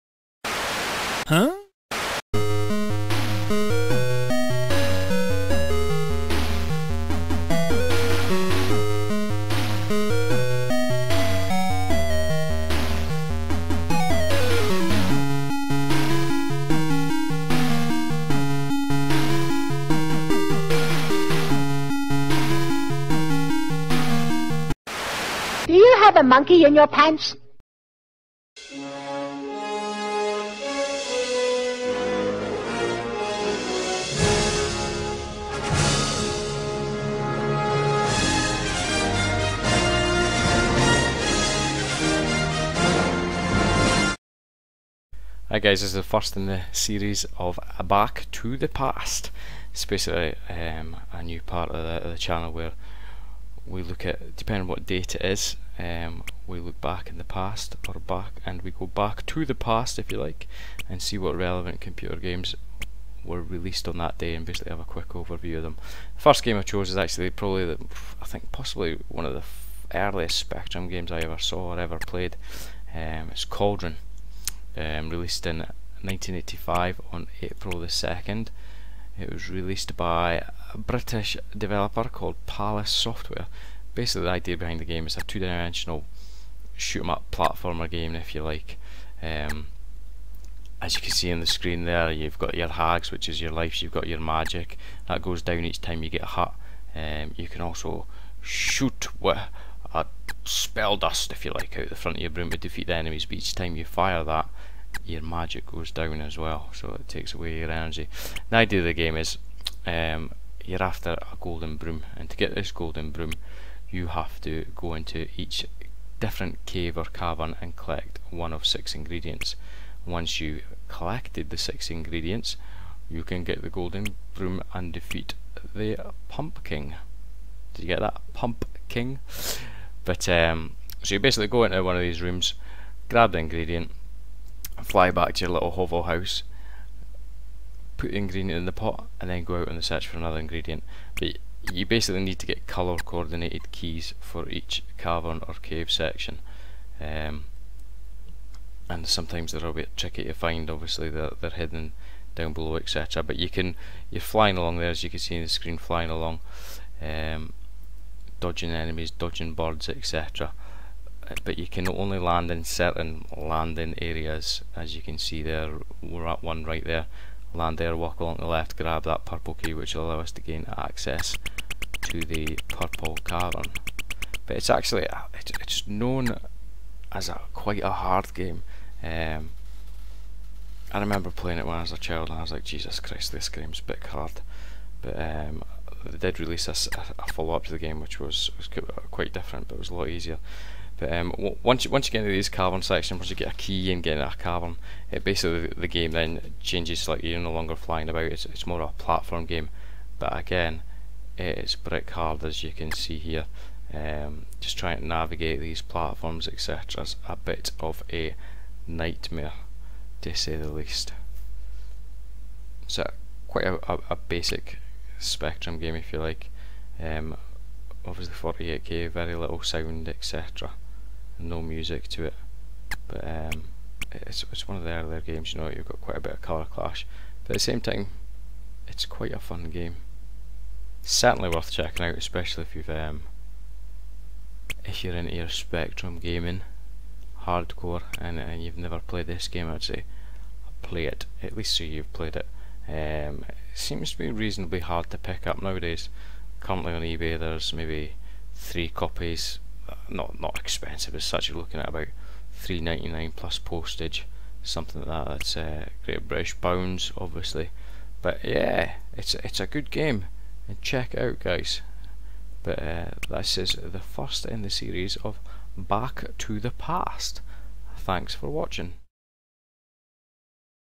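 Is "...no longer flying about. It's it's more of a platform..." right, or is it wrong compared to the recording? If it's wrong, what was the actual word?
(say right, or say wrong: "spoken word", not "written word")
right.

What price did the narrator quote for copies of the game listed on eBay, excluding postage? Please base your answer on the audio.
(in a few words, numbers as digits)
£3.99.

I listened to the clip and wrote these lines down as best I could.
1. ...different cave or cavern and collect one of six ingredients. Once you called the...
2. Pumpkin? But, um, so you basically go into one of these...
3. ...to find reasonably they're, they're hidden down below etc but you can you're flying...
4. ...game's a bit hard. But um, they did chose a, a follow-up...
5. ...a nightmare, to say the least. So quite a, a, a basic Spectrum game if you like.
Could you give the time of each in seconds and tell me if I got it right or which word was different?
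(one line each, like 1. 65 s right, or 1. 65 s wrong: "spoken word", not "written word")
1. 116 s wrong: "collected", not "called"
2. 128 s right
3. 150 s wrong: "obviously", not "reasonably"
4. 183 s wrong: "release", not "chose"
5. 208 s right.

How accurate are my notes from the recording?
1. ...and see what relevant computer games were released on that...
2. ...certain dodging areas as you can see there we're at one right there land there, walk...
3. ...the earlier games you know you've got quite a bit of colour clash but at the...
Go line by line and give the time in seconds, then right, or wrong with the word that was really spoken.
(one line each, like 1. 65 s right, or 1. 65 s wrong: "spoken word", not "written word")
1. 60 s right
2. 162 s wrong: "landing", not "dodging"
3. 224 s right.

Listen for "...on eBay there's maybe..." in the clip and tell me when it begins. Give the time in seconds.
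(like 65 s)
246 s.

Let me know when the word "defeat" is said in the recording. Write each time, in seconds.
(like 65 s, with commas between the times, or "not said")
102 s, 124 s.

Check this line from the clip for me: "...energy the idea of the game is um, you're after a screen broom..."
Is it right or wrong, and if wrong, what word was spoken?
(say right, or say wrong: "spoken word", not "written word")
wrong: "golden", not "screen".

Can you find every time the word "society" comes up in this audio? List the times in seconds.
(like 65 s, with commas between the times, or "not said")
not said.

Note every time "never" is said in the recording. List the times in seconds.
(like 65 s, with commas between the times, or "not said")
238 s.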